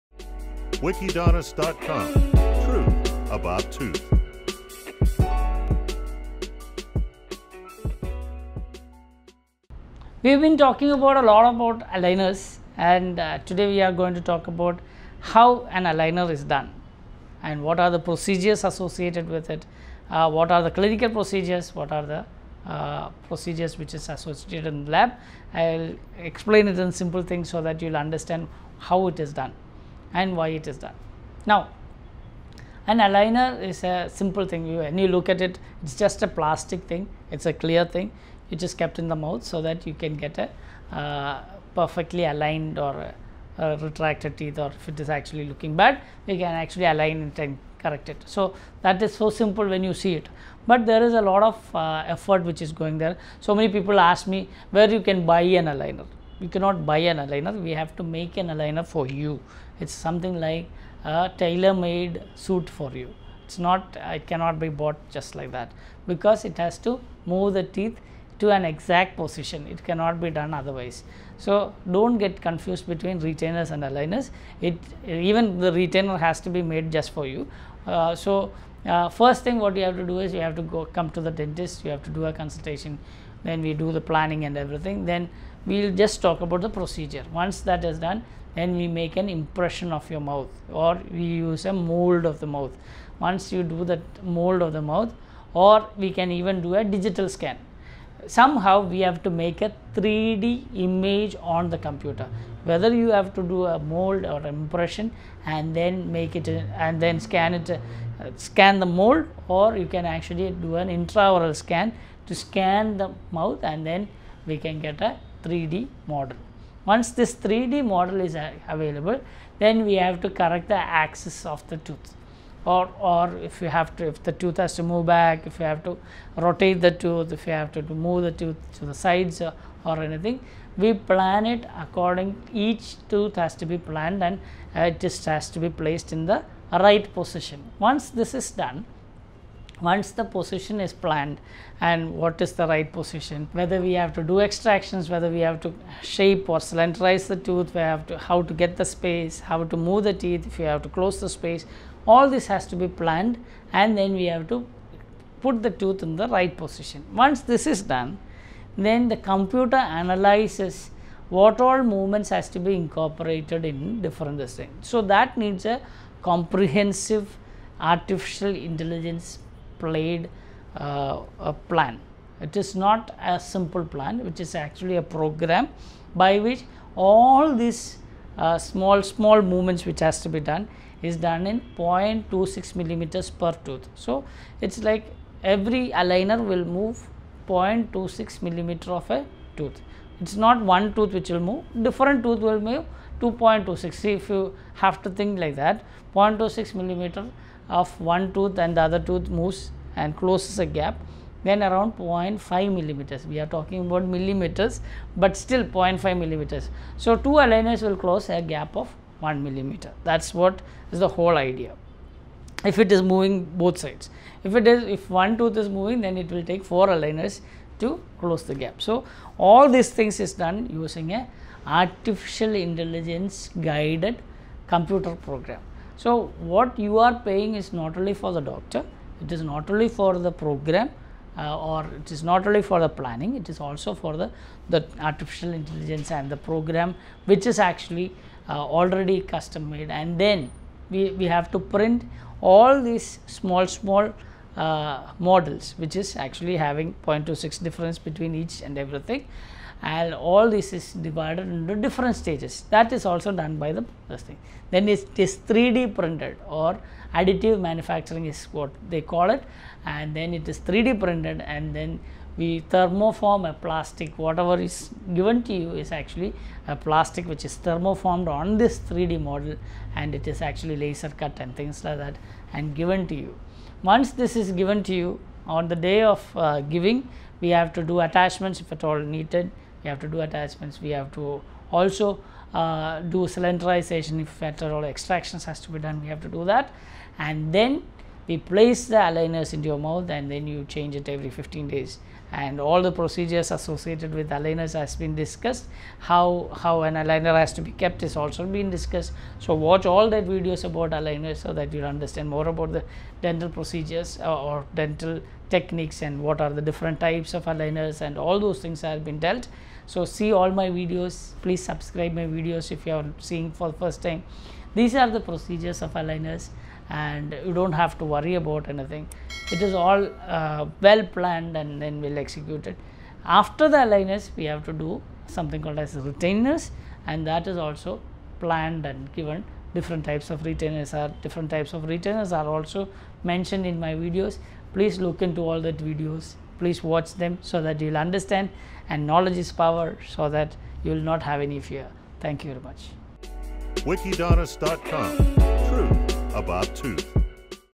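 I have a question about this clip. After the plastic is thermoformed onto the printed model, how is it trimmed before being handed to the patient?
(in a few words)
laser cut.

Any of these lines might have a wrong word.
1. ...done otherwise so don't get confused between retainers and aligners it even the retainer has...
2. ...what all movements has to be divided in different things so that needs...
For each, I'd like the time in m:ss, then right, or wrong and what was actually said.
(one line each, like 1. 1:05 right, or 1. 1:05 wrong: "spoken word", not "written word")
1. 1:10 right
2. 2:41 wrong: "incorporated", not "divided".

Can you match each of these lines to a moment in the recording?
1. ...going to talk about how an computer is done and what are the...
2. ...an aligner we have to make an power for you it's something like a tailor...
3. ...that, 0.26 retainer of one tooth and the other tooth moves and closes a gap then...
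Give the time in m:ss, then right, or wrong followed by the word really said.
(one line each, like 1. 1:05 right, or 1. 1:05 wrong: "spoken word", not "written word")
1. 0:13 wrong: "aligner", not "computer"
2. 0:57 wrong: "aligner", not "power"
3. 3:15 wrong: "millimeter", not "retainer".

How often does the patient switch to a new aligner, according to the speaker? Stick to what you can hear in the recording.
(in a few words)
every 15 days.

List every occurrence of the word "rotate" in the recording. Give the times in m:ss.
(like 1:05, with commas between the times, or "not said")
2:06.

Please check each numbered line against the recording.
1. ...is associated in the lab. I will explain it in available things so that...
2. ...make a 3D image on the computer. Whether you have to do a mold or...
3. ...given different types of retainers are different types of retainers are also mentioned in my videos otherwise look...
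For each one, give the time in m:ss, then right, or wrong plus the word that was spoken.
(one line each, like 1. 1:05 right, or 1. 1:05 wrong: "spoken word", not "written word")
1. 0:23 wrong: "simple", not "available"
2. 1:39 right
3. 5:29 wrong: "please", not "otherwise".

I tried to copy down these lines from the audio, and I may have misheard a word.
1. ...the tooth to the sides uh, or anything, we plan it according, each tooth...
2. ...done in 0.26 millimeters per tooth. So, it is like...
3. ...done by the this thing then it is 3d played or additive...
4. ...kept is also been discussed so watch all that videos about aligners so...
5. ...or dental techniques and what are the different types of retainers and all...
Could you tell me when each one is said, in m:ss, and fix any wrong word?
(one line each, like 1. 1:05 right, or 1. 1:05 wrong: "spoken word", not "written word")
1. 2:08 right
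2. 3:01 right
3. 4:13 wrong: "printed", not "played"
4. 4:57 right
5. 5:04 wrong: "aligners", not "retainers".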